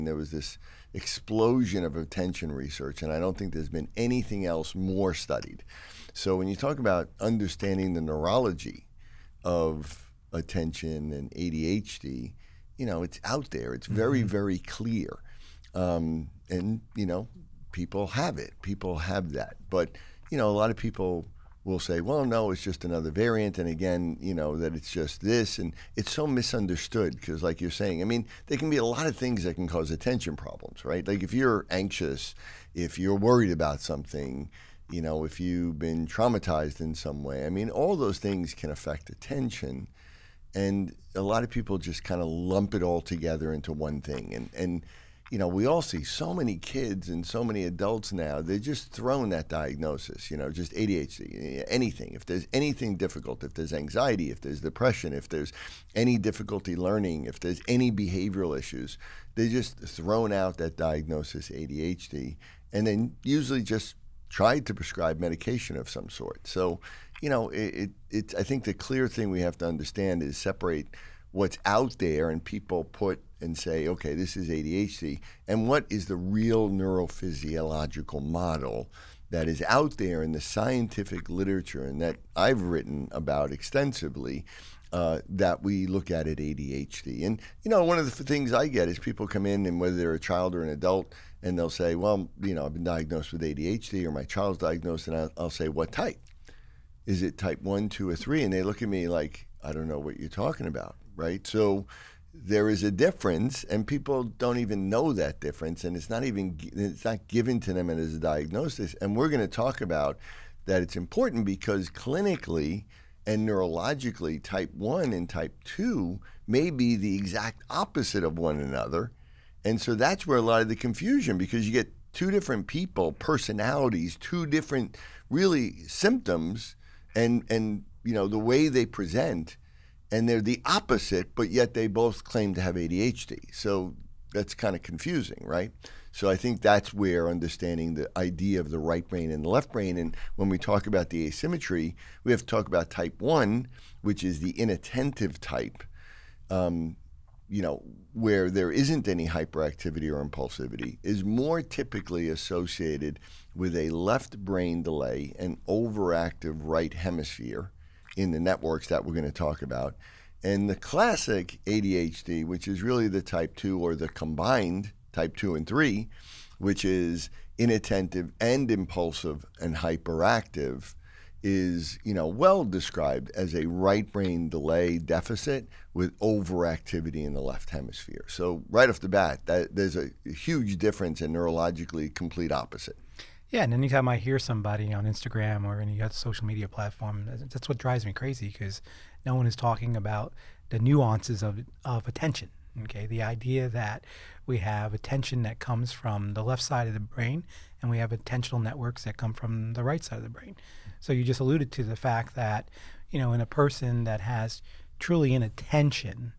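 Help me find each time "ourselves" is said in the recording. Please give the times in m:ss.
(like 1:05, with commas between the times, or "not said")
not said.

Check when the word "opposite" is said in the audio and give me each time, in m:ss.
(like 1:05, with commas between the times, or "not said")
1:57, 2:10, 3:02.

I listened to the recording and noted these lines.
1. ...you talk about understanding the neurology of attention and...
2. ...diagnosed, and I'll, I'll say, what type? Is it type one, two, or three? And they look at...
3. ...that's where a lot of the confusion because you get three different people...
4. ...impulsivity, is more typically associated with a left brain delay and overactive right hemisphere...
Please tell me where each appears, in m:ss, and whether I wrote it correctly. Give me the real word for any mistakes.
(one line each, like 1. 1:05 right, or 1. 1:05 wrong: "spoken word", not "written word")
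1. 0:06 right
2. 1:34 right
3. 1:59 wrong: "two", not "three"
4. 2:30 right.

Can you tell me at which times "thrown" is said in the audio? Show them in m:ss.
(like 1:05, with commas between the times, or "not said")
0:48, 0:59.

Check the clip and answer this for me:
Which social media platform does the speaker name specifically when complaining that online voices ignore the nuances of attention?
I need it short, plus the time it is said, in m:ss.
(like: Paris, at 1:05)
Instagram, at 3:05.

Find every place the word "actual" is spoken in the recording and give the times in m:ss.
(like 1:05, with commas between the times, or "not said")
not said.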